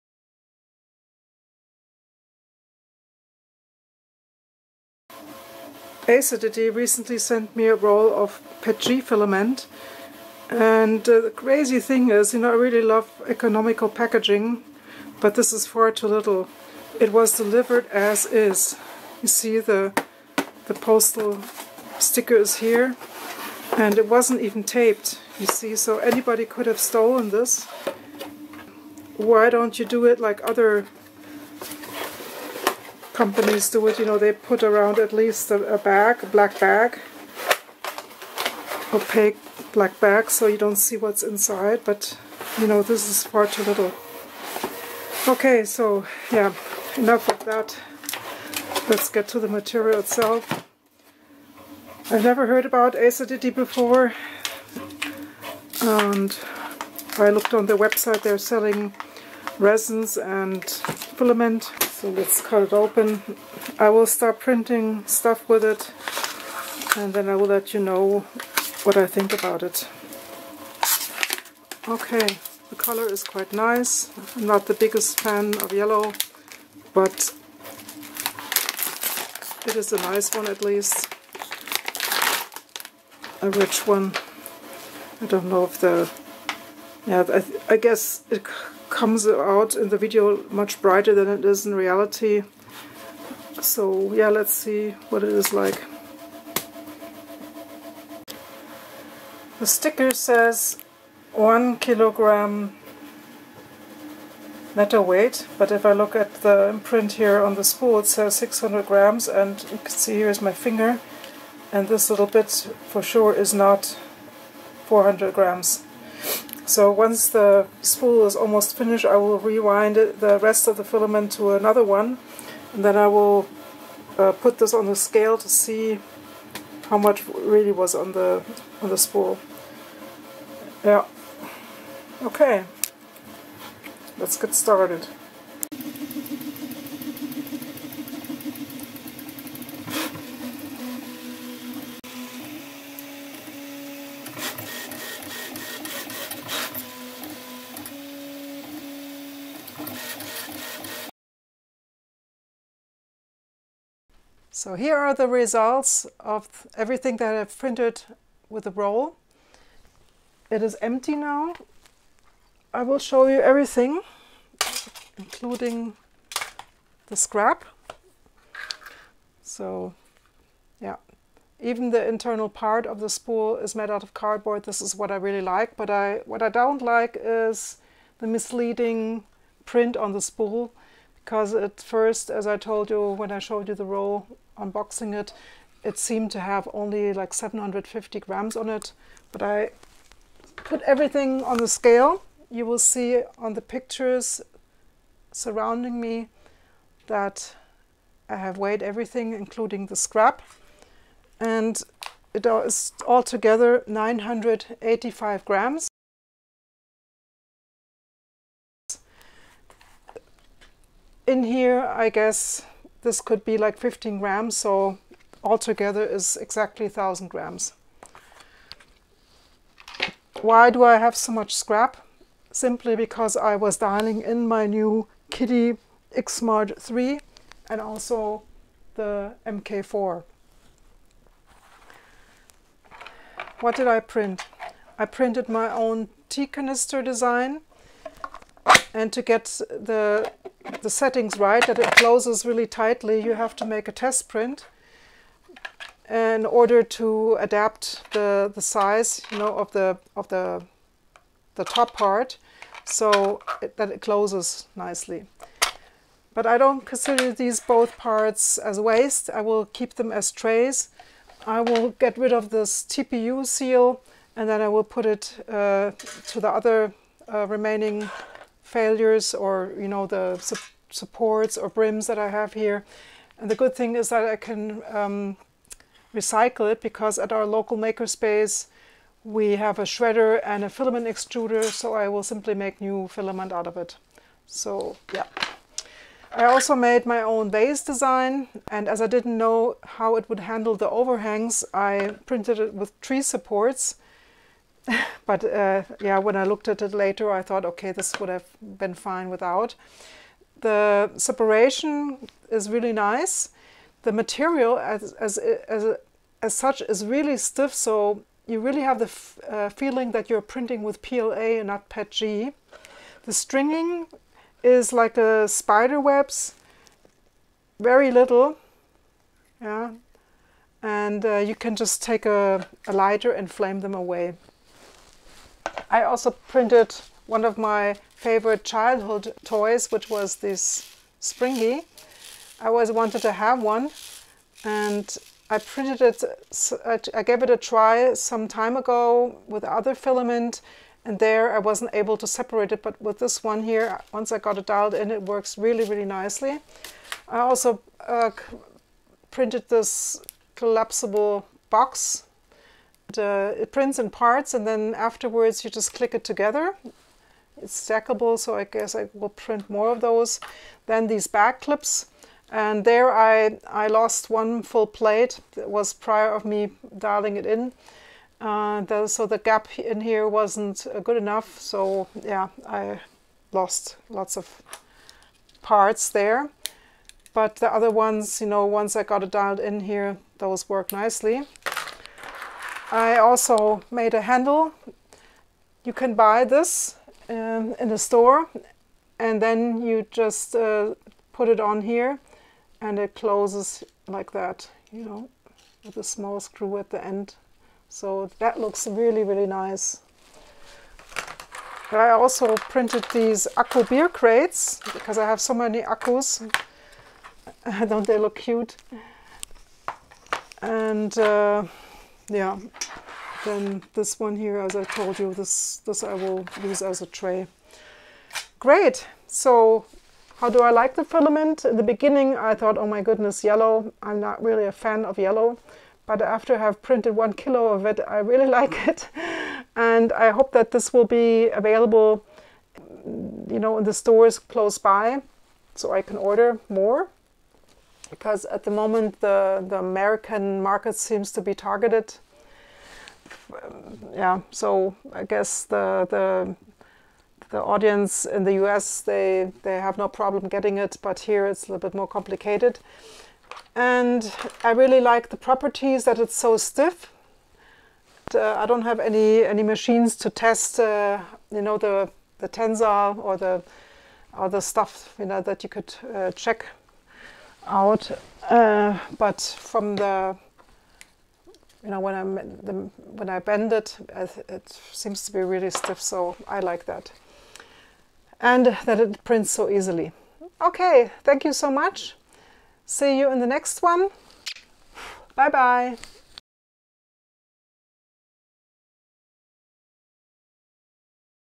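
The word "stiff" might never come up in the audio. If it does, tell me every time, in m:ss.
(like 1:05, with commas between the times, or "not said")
5:07, 7:36, 7:55.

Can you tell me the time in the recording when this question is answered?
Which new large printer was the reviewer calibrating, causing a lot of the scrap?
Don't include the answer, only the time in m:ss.
3:45.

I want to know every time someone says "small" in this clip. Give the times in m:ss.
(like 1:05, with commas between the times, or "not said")
6:36.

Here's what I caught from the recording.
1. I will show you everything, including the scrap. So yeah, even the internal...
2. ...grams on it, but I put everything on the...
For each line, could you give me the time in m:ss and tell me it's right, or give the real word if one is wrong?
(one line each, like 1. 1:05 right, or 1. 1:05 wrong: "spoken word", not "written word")
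1. 2:42 right
2. 3:08 right.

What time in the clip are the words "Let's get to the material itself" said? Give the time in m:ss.
0:48.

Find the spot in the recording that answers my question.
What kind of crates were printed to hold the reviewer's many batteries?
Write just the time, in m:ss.
6:43.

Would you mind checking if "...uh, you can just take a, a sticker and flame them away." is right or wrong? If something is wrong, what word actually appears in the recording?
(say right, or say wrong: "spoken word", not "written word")
wrong: "lighter", not "sticker".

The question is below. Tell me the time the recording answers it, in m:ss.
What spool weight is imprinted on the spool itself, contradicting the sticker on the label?
1:48.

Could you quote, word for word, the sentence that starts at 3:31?
in here, I guess this could be like 15 grams, so altogether is exactly 1000 grams.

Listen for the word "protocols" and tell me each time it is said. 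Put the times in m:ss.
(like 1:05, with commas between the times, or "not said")
not said.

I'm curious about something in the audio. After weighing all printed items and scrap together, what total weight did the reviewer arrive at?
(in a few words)
985 grams.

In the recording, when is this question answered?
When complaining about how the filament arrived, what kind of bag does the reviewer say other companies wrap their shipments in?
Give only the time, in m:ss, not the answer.
0:38.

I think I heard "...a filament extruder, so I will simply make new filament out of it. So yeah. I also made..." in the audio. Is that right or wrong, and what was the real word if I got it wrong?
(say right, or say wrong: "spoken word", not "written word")
right.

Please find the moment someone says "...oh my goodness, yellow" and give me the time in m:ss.
7:02.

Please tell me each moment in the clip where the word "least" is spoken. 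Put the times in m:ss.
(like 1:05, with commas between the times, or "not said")
0:35, 1:20.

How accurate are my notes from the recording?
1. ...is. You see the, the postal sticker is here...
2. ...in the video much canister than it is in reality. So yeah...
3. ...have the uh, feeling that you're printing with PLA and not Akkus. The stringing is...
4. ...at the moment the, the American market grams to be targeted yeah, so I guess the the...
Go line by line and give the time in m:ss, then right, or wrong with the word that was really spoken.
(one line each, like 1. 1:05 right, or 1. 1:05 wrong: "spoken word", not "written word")
1. 0:18 right
2. 1:29 wrong: "brighter", not "canister"
3. 5:08 wrong: "PETG", not "Akkus"
4. 7:18 wrong: "seems", not "grams".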